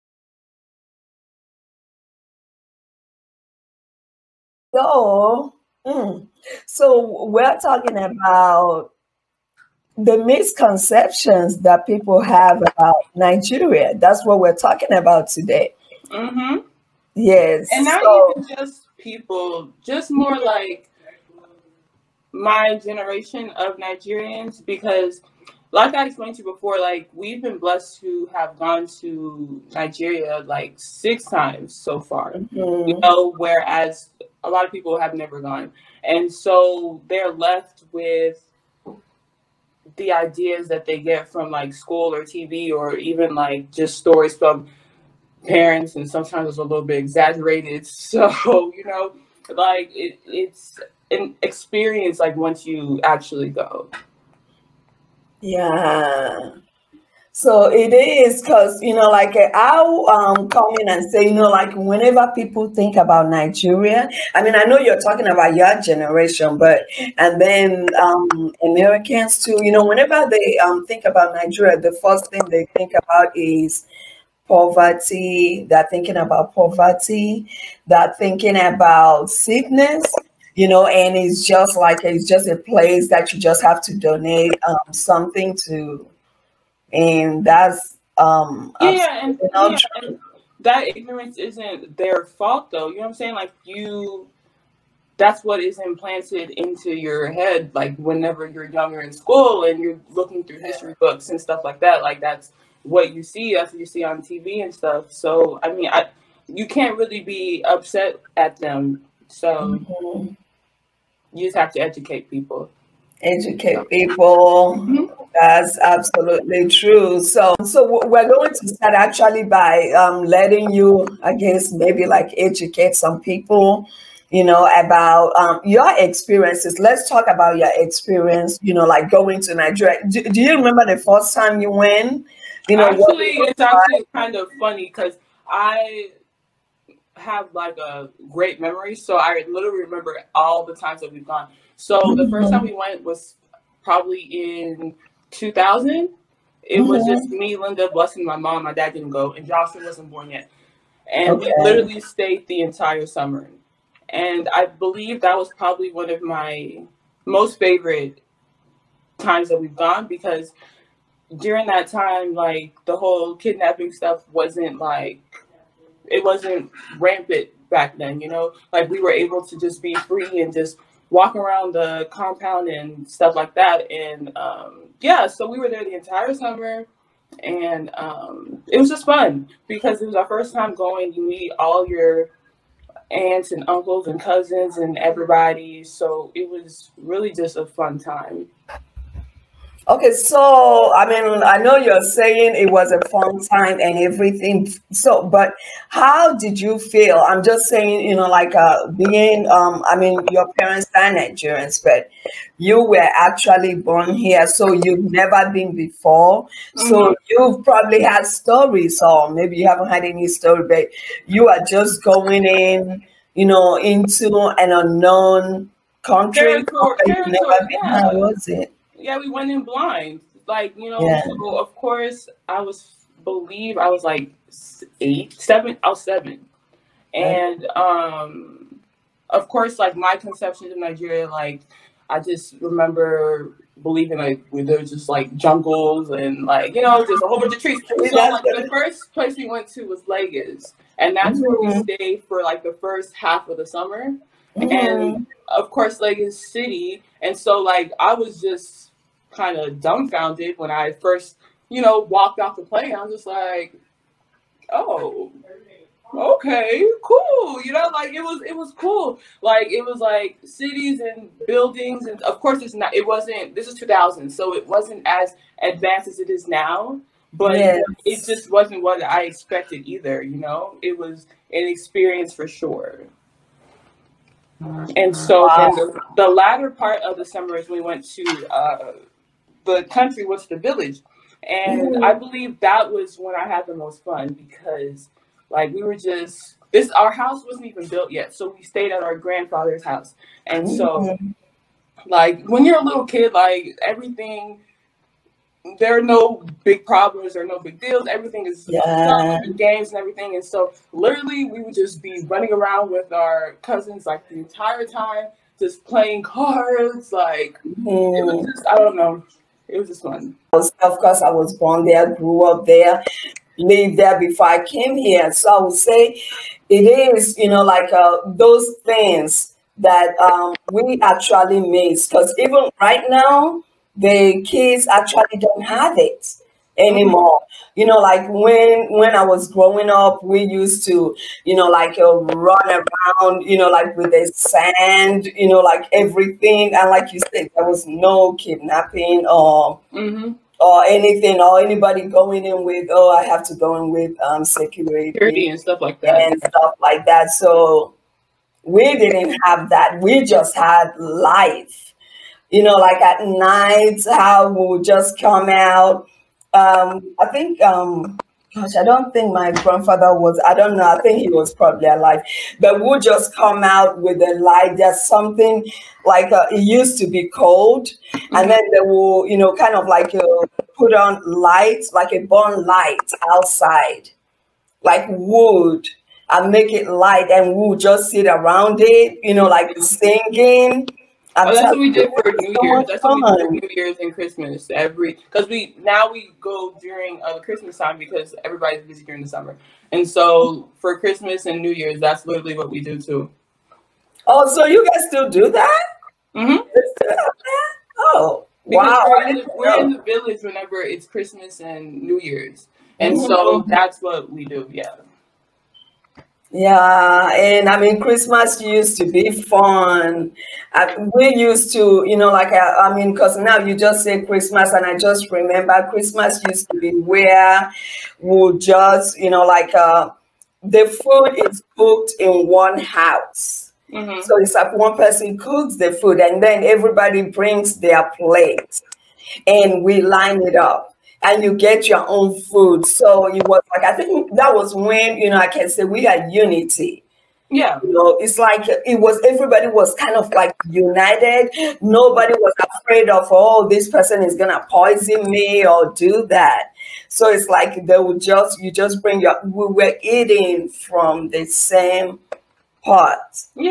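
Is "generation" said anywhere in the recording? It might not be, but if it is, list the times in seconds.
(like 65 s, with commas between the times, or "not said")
22 s, 65 s.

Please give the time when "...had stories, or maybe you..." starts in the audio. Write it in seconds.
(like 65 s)
208 s.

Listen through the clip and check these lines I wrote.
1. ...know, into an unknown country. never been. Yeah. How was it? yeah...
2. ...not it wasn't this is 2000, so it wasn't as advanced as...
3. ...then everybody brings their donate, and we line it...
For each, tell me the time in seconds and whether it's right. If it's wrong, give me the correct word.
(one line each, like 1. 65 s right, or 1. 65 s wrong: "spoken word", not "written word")
1. 213 s right
2. 262 s right
3. 426 s wrong: "plate", not "donate".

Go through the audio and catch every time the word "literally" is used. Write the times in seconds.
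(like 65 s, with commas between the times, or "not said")
139 s, 151 s, 300 s, 392 s.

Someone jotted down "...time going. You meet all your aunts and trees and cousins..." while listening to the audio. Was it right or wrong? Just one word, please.
wrong.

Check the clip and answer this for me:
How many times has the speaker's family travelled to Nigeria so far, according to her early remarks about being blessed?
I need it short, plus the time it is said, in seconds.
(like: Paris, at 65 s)
6, at 30 s.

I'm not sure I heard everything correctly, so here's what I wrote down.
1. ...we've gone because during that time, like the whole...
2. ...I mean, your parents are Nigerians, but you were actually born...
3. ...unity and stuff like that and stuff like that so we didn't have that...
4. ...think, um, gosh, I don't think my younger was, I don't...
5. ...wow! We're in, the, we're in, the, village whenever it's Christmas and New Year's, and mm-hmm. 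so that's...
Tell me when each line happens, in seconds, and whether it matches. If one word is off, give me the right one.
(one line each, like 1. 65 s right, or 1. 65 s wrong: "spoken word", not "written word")
1. 159 s right
2. 199 s right
3. 345 s wrong: "security", not "unity"
4. 357 s wrong: "grandfather", not "younger"
5. 398 s right.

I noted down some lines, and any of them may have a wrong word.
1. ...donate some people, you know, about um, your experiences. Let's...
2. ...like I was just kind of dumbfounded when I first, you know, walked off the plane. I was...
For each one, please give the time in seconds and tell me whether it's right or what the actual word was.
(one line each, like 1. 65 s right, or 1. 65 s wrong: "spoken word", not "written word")
1. 122 s wrong: "educate", not "donate"
2. 247 s right.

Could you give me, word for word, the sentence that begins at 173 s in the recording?
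And um, yeah, so we were there the entire summer.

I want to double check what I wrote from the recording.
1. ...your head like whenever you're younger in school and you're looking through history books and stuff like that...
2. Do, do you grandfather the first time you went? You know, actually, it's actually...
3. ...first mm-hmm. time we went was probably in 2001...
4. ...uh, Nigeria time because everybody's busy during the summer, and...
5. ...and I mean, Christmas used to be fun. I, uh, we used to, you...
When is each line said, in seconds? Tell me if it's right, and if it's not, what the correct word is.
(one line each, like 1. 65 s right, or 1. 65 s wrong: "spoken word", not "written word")
1. 96 s right
2. 130 s wrong: "remember", not "grandfather"
3. 142 s wrong: "2000", not "2001"
4. 387 s wrong: "Christmas", not "Nigeria"
5. 407 s right.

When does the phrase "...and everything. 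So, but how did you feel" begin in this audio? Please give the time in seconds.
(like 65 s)
193 s.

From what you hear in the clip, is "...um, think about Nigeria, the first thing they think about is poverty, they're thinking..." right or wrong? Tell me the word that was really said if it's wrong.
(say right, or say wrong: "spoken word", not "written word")
right.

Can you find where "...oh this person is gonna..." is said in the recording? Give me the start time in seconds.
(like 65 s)
443 s.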